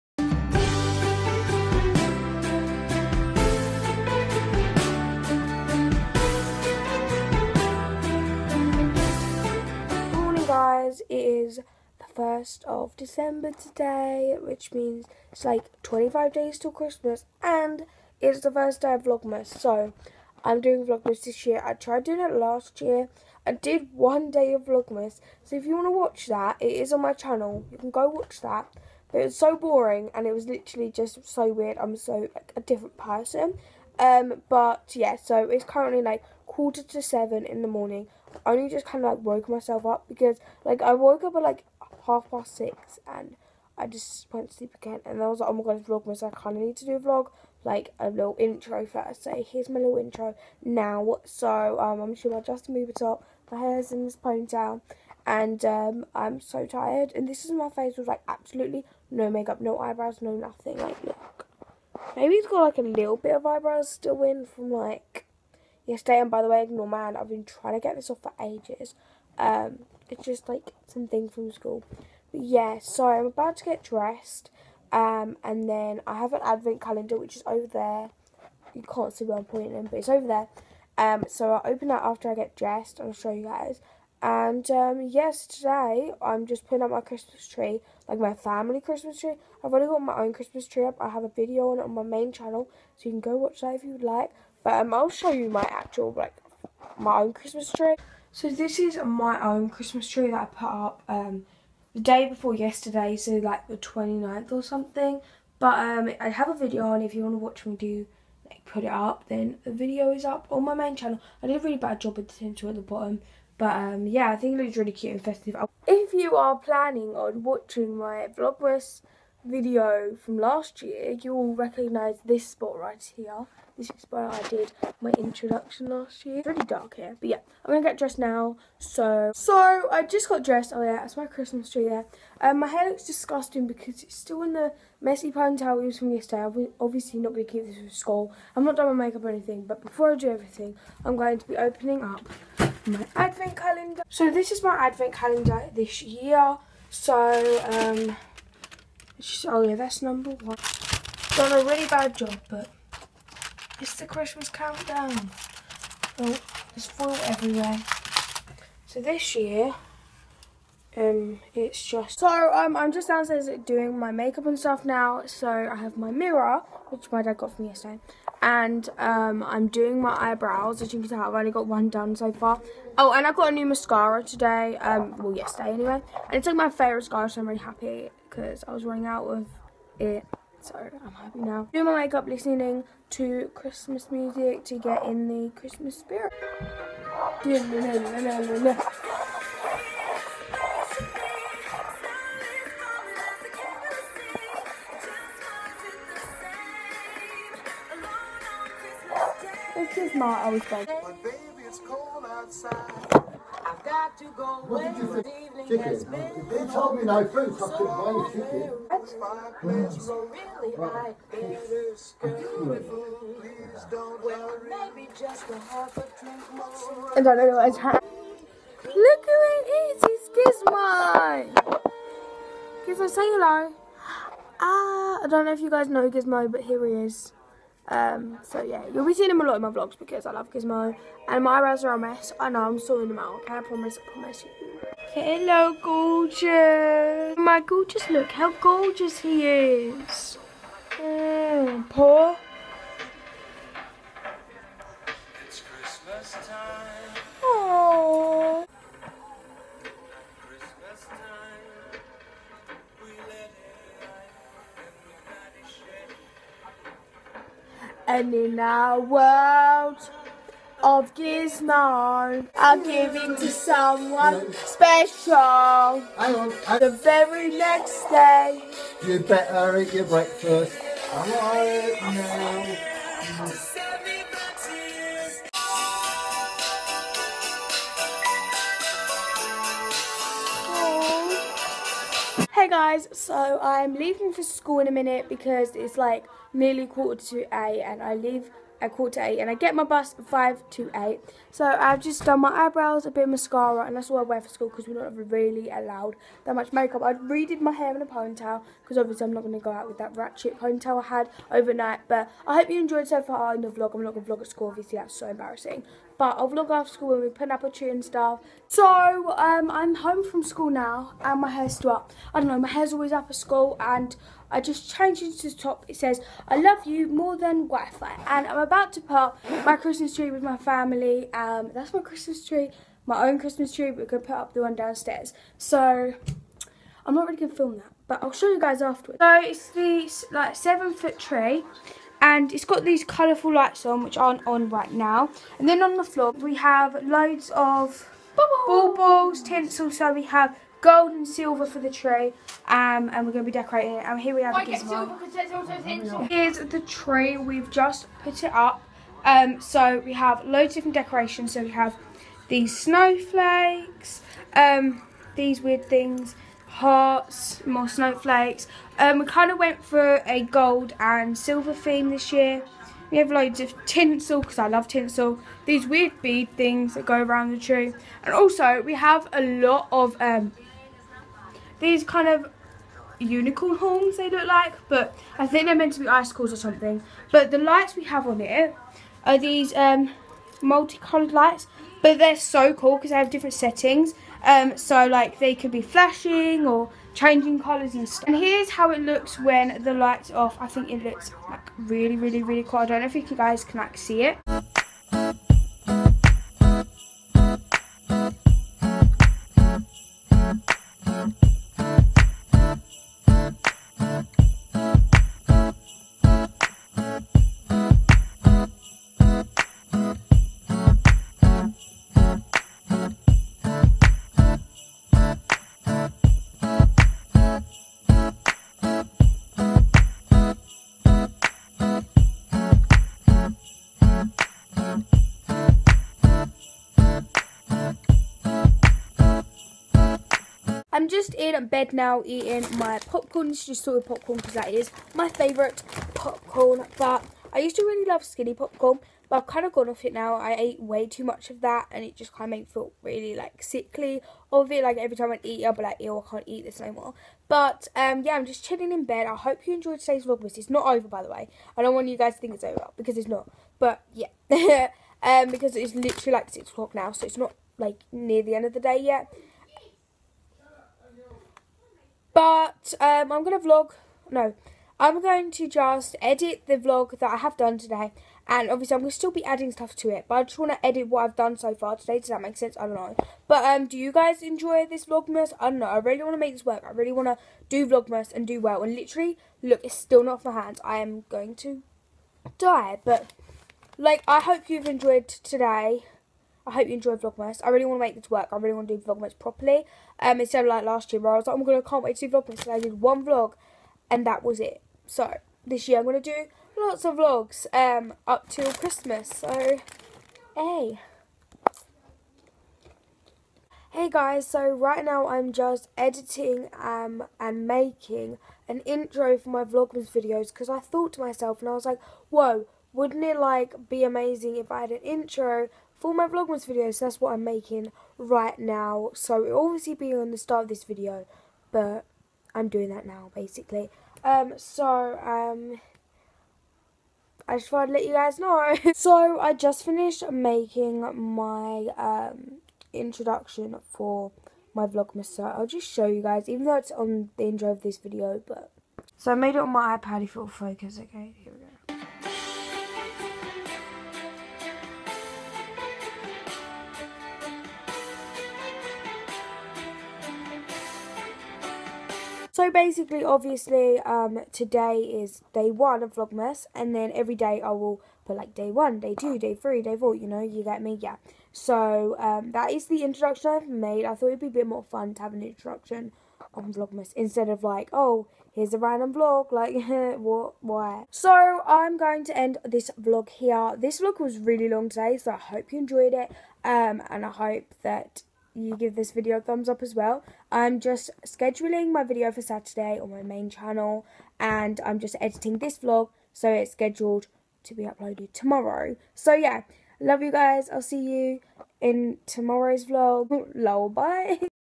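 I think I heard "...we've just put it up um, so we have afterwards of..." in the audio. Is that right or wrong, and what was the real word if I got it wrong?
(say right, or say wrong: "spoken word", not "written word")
wrong: "loads", not "afterwards".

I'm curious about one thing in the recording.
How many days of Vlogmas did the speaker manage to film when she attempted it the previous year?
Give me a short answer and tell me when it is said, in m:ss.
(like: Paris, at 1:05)
1, at 0:23.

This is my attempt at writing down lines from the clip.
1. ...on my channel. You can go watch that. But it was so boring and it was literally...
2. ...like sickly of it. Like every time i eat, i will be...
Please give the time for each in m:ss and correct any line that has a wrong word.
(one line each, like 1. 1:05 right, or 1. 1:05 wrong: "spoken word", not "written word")
1. 0:26 right
2. 7:23 right.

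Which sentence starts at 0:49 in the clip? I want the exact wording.
So here's my little intro now.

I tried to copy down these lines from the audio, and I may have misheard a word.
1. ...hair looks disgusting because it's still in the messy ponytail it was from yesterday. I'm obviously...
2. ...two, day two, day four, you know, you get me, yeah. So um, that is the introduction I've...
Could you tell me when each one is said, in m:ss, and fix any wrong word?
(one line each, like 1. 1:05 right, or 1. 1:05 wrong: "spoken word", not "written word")
1. 2:12 right
2. 9:19 wrong: "three", not "two".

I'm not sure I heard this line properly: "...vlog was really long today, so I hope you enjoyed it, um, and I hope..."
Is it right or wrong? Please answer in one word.
right.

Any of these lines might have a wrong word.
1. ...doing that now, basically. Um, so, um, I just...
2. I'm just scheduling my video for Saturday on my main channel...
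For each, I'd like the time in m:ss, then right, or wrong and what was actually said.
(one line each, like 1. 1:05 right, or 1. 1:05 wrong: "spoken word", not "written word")
1. 8:42 right
2. 9:40 right.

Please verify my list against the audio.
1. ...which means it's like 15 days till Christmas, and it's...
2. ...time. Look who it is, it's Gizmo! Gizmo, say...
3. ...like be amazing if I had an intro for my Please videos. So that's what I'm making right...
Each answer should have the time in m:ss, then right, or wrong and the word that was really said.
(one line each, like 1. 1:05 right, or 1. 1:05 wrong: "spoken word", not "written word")
1. 0:14 wrong: "25", not "15"
2. 3:37 right
3. 8:33 wrong: "Vlogmas", not "Please".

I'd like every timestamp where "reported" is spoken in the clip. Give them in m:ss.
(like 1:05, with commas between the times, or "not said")
not said.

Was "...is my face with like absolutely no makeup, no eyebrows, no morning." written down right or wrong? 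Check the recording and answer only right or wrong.
wrong.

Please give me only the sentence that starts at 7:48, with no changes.
And obviously, I'm going to still be adding stuff to it.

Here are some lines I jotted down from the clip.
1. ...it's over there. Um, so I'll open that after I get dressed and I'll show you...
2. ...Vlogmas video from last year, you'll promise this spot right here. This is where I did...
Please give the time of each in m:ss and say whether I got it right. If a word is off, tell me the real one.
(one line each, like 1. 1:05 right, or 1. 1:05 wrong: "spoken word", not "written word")
1. 1:19 right
2. 1:58 wrong: "recognise", not "promise".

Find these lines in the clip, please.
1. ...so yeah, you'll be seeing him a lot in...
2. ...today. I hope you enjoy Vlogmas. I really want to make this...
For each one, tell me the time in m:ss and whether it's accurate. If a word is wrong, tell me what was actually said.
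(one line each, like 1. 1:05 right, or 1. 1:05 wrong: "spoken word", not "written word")
1. 3:48 right
2. 8:05 right.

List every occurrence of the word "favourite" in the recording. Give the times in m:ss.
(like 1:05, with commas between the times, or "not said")
2:56, 7:15.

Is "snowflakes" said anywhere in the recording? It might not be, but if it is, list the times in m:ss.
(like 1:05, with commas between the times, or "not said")
5:52, 5:57.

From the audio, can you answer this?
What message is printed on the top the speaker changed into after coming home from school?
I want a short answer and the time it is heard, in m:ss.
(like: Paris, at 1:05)
I love you more than Wi-Fi, at 5:16.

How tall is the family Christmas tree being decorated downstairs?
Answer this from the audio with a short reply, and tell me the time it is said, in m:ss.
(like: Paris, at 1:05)
7 foot, at 5:30.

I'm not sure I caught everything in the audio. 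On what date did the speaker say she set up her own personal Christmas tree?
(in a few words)
29th.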